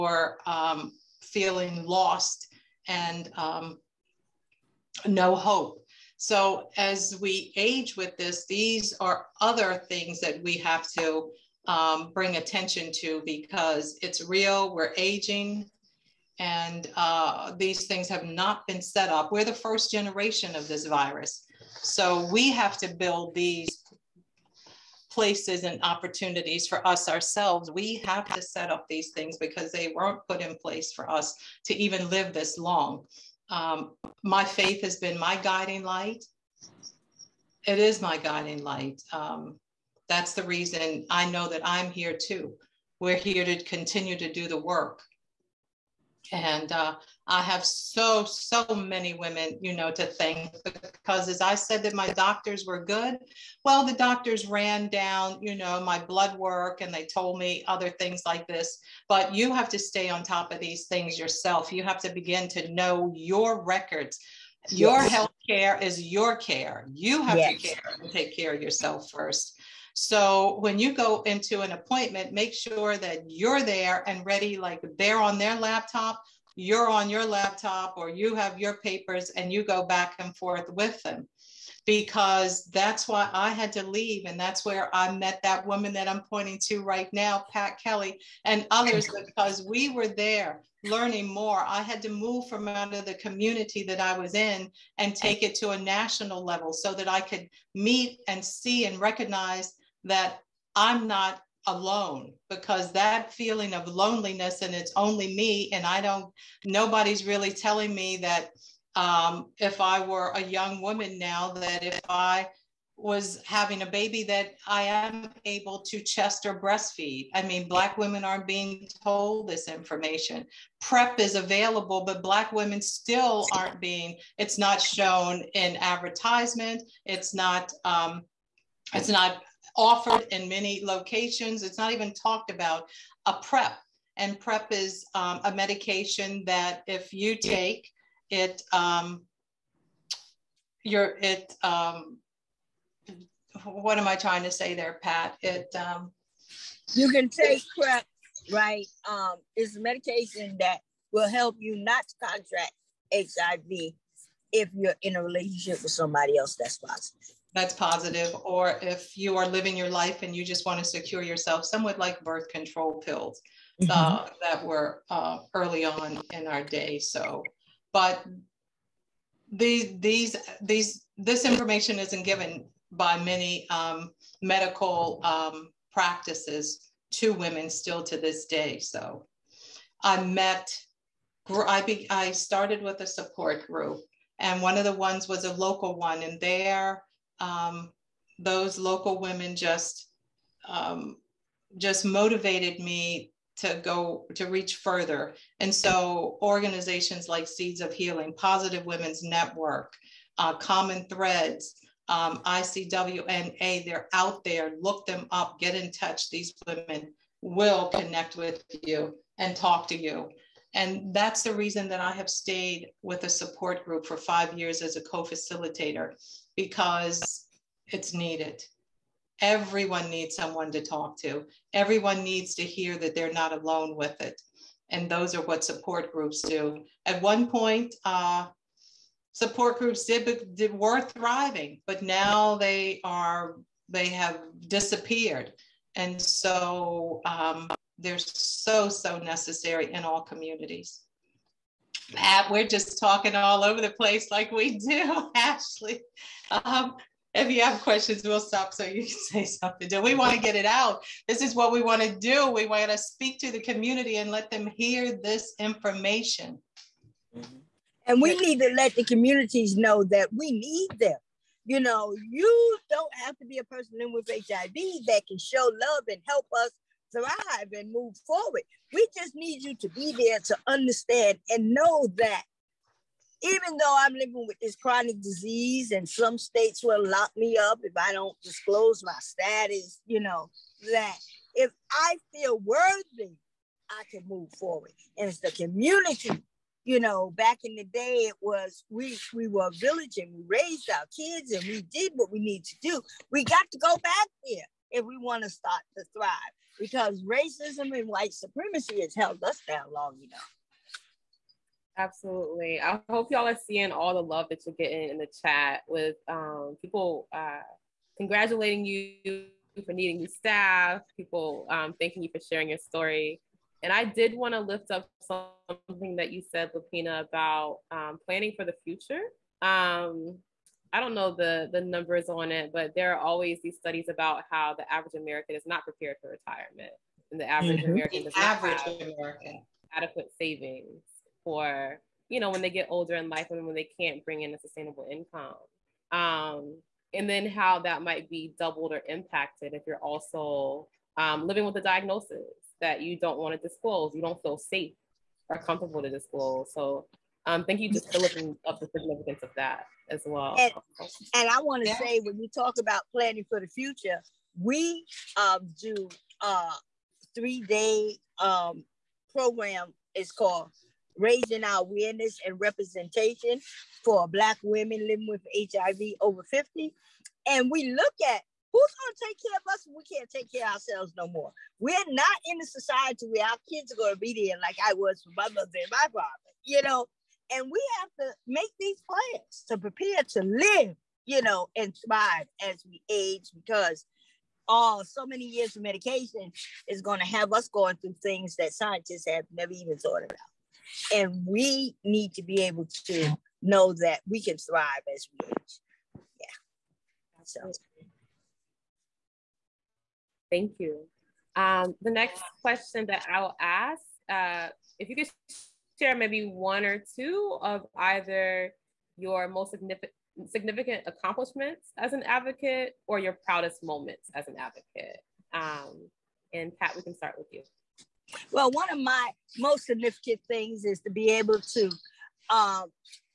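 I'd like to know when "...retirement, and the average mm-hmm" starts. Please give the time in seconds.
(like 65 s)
326 s.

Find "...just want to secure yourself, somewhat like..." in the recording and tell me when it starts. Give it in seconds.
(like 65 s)
160 s.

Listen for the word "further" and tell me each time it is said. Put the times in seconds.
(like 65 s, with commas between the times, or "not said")
194 s.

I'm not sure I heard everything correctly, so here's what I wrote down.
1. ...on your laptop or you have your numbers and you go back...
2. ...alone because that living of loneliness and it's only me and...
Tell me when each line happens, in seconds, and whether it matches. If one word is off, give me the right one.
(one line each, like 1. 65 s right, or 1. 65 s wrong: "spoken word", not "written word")
1. 76 s wrong: "papers", not "numbers"
2. 101 s wrong: "feeling", not "living".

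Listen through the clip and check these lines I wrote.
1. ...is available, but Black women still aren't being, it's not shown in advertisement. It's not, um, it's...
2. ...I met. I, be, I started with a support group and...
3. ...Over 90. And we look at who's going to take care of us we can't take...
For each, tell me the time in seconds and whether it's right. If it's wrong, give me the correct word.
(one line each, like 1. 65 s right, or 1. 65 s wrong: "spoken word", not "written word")
1. 121 s right
2. 180 s right
3. 366 s wrong: "50", not "90".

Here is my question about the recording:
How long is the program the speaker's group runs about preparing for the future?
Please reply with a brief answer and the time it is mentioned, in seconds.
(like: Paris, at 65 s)
3 days, at 357 s.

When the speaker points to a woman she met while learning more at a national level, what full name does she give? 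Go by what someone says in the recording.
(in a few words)
Pat Kelly.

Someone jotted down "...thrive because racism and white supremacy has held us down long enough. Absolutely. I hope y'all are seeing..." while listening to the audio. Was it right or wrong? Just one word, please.
right.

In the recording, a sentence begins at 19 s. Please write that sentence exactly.
We're the first generation of this virus.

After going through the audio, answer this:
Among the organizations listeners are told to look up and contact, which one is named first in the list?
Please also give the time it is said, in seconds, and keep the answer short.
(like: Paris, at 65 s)
Seeds of Healing, at 197 s.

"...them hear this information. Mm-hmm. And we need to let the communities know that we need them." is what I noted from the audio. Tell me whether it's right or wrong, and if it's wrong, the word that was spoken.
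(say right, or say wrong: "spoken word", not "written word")
right.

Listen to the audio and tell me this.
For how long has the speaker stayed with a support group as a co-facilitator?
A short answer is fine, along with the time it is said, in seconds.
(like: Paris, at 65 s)
5 years, at 214 s.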